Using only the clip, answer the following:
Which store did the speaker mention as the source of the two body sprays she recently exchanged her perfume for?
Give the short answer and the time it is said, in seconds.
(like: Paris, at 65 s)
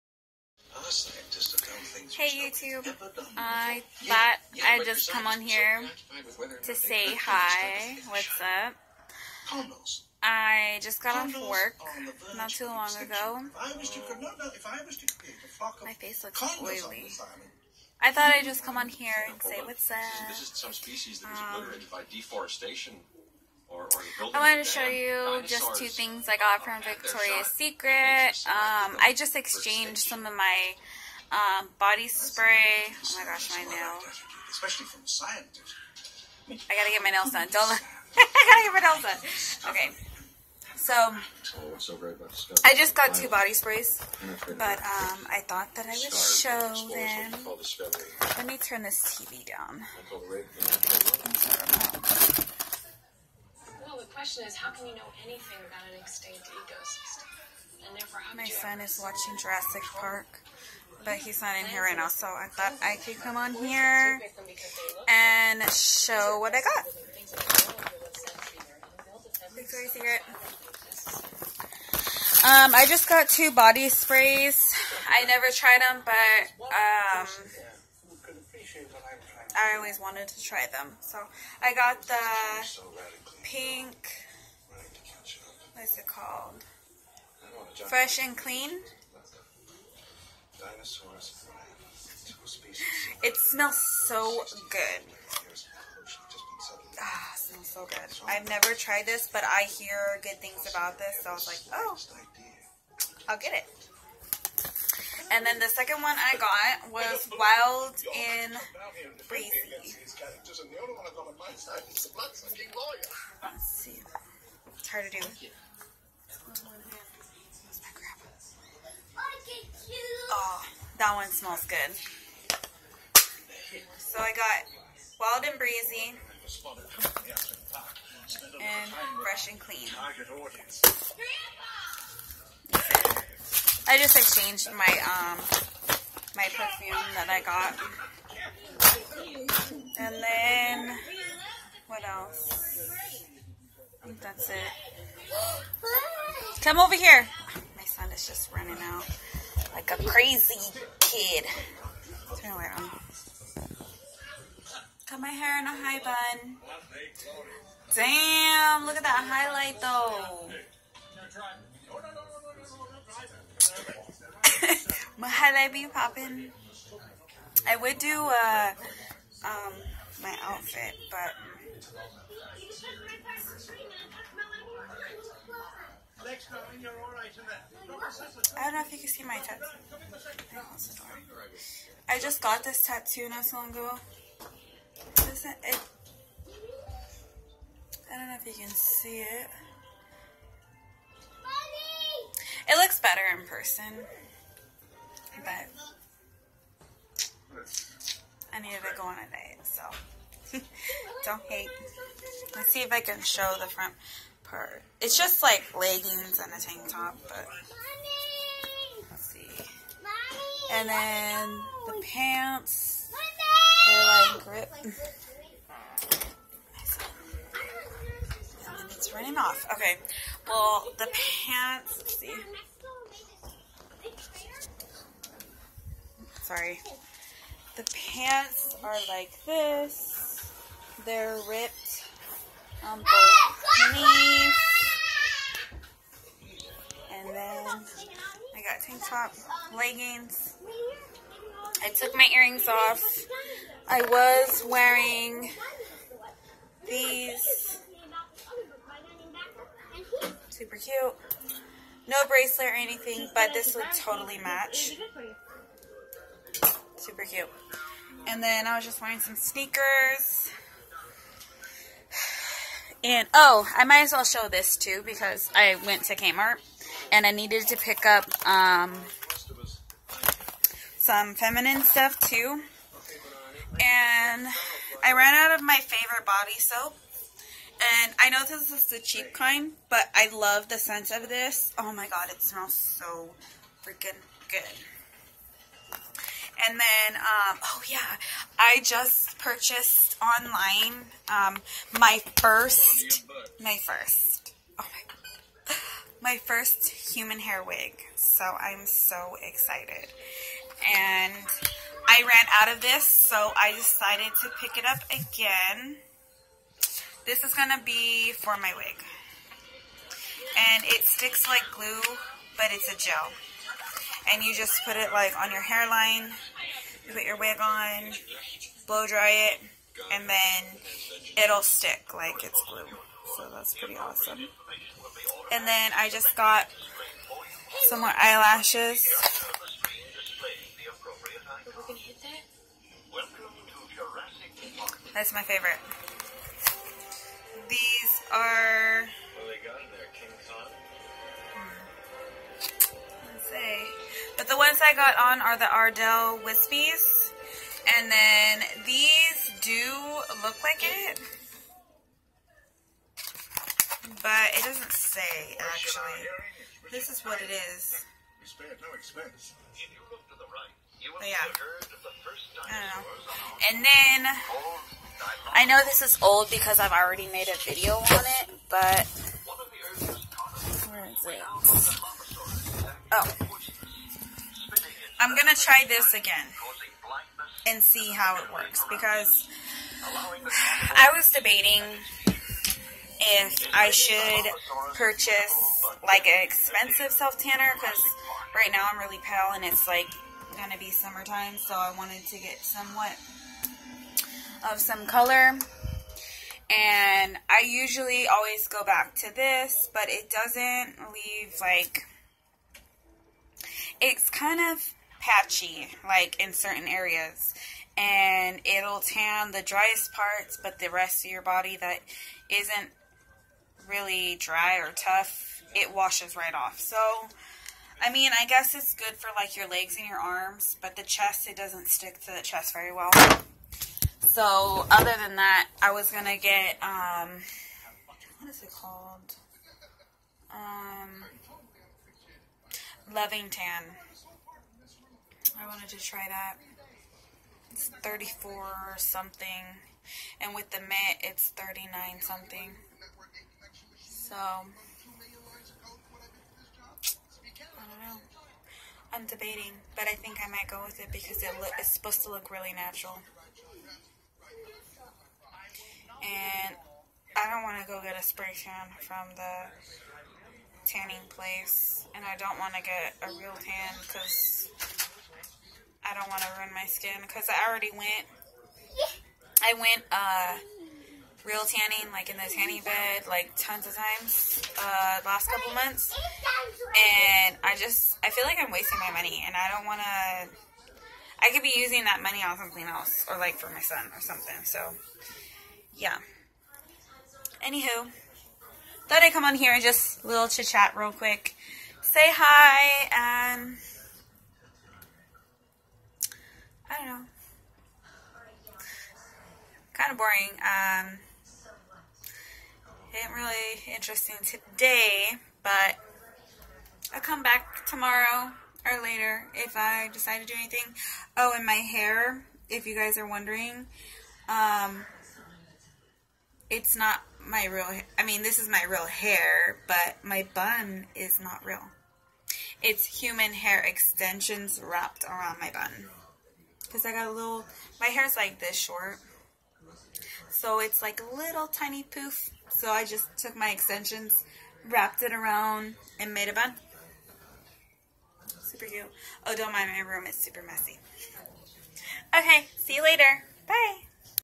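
Victoria's Secret, at 26 s.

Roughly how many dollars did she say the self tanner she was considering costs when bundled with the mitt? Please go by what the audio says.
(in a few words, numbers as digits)
39.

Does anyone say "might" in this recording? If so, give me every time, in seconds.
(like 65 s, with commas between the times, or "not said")
263 s, 450 s.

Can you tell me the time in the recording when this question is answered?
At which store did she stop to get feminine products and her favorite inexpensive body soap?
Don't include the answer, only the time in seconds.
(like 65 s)
266 s.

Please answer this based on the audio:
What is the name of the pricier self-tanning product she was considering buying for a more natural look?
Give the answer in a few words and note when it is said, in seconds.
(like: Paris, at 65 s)
Loving Tan, at 433 s.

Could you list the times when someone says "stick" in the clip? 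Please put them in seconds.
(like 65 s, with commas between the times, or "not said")
311 s, 321 s, 421 s.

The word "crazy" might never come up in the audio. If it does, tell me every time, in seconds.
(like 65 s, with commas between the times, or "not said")
150 s.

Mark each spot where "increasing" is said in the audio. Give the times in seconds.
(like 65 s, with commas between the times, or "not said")
not said.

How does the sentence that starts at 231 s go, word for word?
They're ripped um, on both knees.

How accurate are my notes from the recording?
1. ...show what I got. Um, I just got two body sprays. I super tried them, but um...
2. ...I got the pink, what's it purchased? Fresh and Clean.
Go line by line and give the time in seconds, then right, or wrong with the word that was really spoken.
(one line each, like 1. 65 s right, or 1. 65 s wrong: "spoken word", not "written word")
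1. 65 s wrong: "never", not "super"
2. 81 s wrong: "called", not "purchased".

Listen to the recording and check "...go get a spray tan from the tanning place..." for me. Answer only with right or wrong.
right.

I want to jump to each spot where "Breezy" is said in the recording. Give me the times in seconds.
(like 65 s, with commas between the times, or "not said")
109 s, 125 s.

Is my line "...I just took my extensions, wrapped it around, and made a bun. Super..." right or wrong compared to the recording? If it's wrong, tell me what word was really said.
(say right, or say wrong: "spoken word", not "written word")
right.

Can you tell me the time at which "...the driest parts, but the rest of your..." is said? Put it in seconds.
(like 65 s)
409 s.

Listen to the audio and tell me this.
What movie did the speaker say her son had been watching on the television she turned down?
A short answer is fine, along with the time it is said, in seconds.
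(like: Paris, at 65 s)
Jurassic Park, at 59 s.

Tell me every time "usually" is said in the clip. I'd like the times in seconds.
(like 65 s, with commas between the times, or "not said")
397 s.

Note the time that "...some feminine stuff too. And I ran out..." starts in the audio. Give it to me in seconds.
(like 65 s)
270 s.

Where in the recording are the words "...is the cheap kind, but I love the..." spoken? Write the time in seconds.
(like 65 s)
278 s.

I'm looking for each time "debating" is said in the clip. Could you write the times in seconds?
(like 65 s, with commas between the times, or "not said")
381 s, 449 s.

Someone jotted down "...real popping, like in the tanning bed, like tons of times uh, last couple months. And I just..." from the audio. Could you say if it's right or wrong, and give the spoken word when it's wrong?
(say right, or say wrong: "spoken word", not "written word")
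wrong: "tanning", not "popping".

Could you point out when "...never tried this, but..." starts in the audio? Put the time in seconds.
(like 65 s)
98 s.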